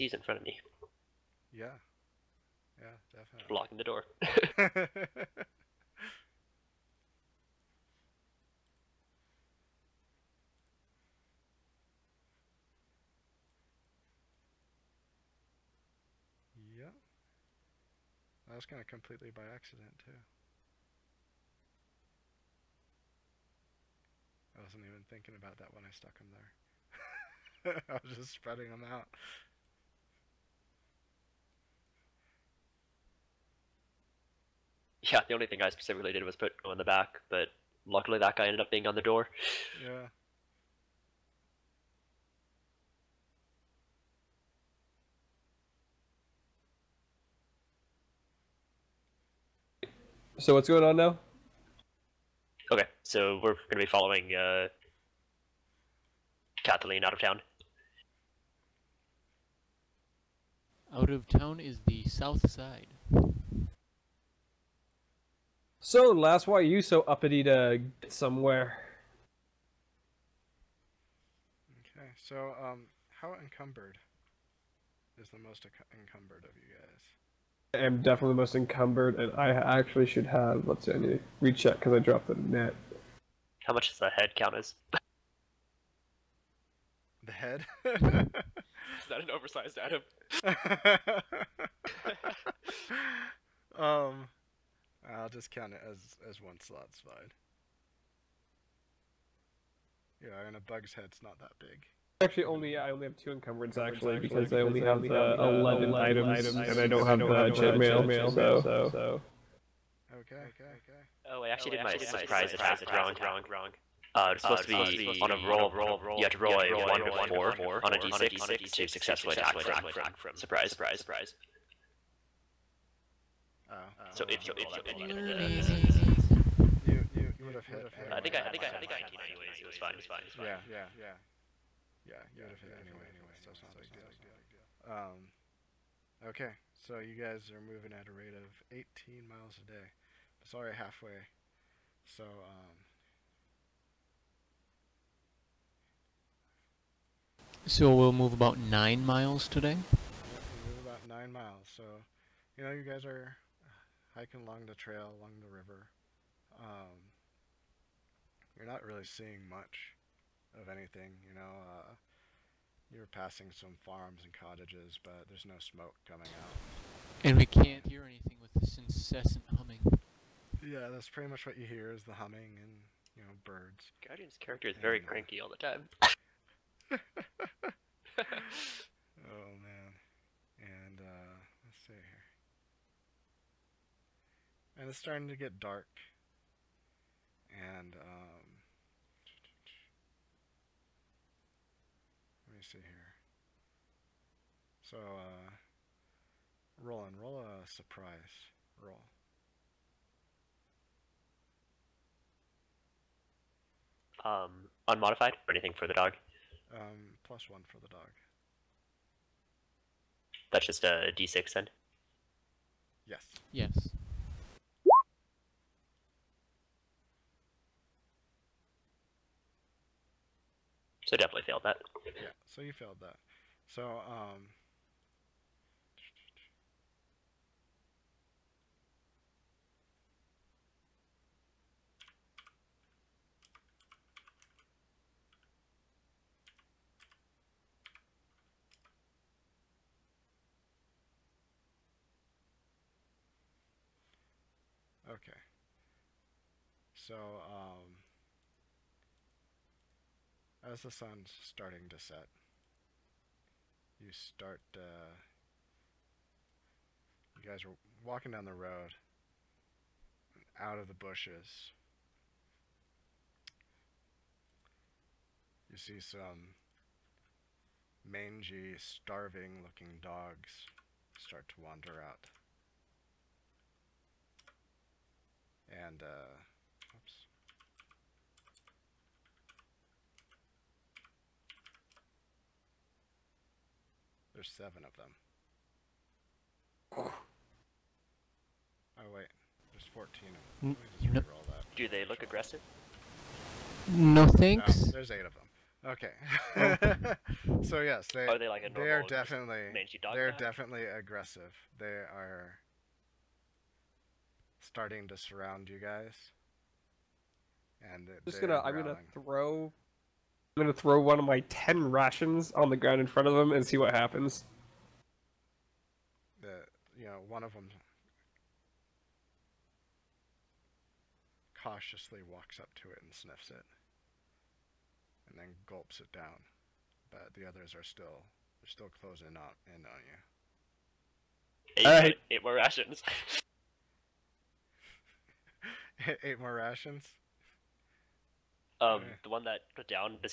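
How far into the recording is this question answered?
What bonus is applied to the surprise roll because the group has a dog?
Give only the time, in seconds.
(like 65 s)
207 s.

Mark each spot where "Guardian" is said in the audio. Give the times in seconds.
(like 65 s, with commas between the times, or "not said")
174 s.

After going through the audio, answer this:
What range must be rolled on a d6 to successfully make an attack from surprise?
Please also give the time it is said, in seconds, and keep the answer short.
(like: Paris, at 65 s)
1 to 4, at 116 s.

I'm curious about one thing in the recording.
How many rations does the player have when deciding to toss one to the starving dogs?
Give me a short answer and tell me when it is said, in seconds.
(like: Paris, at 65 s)
10, at 311 s.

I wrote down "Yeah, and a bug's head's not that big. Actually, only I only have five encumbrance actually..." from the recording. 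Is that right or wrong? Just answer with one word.
wrong.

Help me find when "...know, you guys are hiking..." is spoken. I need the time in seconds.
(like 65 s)
152 s.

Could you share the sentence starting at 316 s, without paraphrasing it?
The, you know, one of them cautiously walks up to it and sniffs it.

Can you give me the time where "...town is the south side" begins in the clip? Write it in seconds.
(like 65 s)
61 s.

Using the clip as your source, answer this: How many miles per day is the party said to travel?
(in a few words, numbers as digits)
18.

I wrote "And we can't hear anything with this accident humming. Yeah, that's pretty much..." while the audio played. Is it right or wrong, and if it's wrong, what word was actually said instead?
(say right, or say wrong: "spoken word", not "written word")
wrong: "incessant", not "accident".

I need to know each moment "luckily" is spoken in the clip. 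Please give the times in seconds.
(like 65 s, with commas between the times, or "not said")
37 s.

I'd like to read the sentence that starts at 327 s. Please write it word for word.
But the others are still, they're still closing up in on you.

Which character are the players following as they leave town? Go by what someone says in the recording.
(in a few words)
Kathleen.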